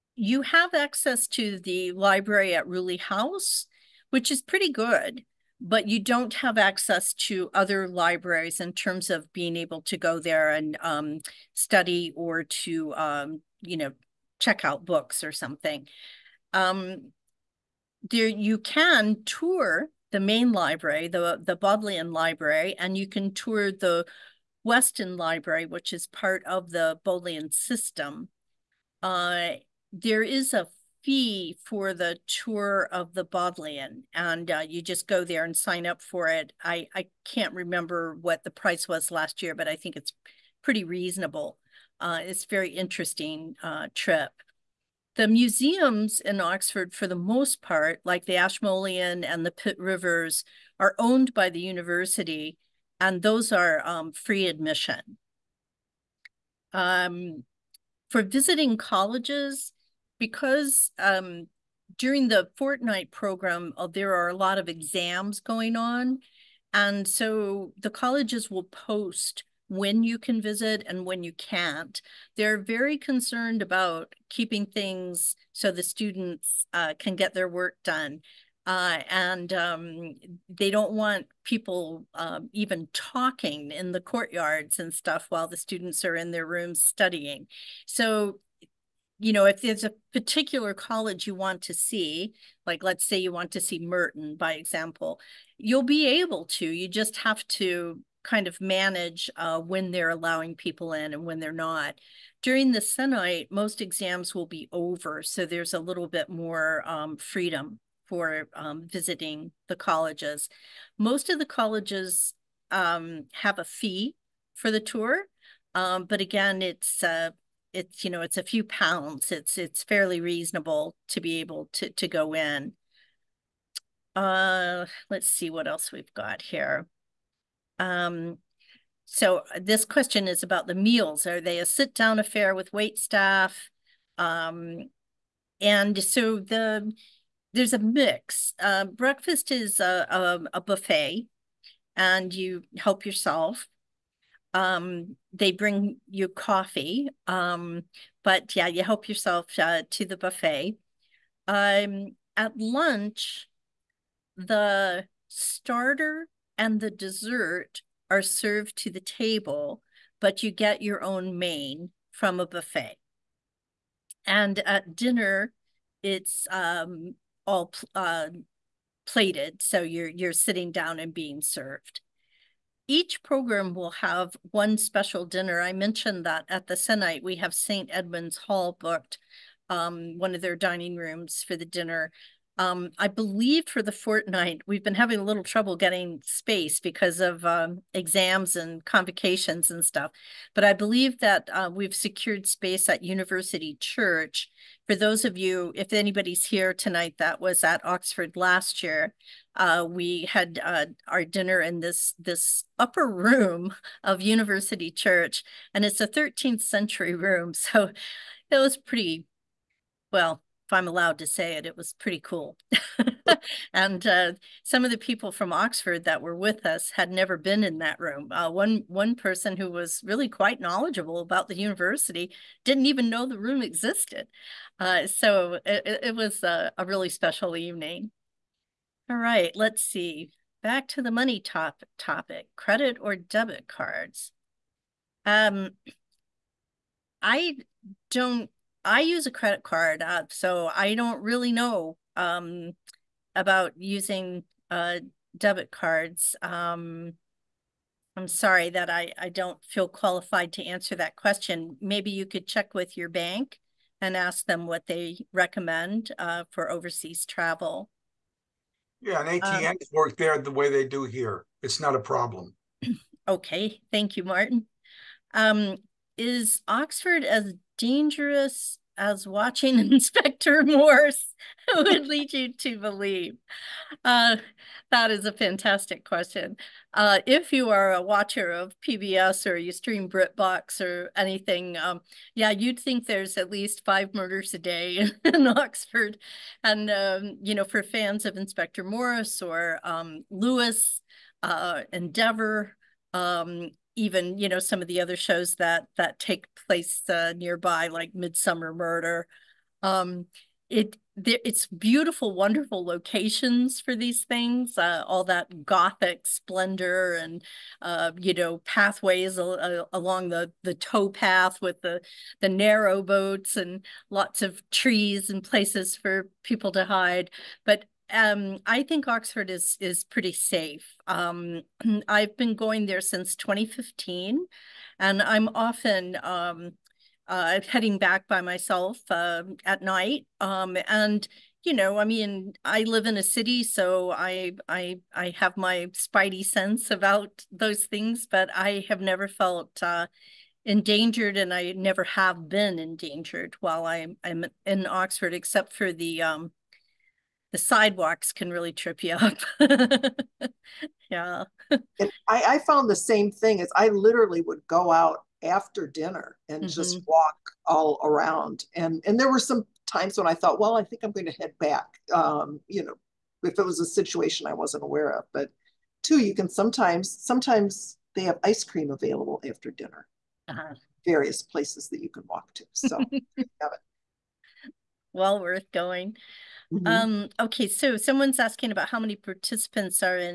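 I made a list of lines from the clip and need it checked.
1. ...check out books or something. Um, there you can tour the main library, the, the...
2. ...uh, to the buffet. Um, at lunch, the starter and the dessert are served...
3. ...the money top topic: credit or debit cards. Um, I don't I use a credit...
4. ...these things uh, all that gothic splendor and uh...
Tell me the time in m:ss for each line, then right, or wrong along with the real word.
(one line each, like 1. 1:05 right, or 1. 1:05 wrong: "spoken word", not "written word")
1. 0:14 right
2. 2:29 right
3. 3:51 right
4. 5:03 right.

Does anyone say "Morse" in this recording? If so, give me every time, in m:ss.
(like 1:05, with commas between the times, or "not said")
4:30, 4:48.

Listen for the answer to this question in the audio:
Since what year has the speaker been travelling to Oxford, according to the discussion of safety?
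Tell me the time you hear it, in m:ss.
5:23.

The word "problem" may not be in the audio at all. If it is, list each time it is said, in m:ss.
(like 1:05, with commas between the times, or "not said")
4:22.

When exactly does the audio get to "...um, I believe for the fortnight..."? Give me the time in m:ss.
3:02.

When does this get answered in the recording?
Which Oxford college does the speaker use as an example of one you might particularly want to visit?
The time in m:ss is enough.
1:33.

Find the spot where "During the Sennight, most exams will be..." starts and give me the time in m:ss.
1:42.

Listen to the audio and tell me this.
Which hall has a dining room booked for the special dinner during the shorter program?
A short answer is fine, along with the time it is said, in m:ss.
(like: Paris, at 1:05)
St. Edmund's Hall, at 2:57.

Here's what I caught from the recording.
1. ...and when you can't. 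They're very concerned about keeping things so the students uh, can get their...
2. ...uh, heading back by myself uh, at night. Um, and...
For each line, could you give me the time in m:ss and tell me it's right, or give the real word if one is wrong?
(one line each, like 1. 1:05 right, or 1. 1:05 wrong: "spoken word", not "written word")
1. 1:10 right
2. 5:27 right.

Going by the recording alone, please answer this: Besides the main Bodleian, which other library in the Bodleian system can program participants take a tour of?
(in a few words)
Weston Library.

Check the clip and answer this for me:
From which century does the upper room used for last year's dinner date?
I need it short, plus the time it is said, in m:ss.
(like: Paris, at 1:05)
13th century, at 3:26.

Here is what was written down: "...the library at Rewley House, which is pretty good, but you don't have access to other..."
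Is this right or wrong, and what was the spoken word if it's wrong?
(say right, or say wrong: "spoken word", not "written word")
right.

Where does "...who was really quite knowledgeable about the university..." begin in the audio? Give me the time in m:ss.
3:39.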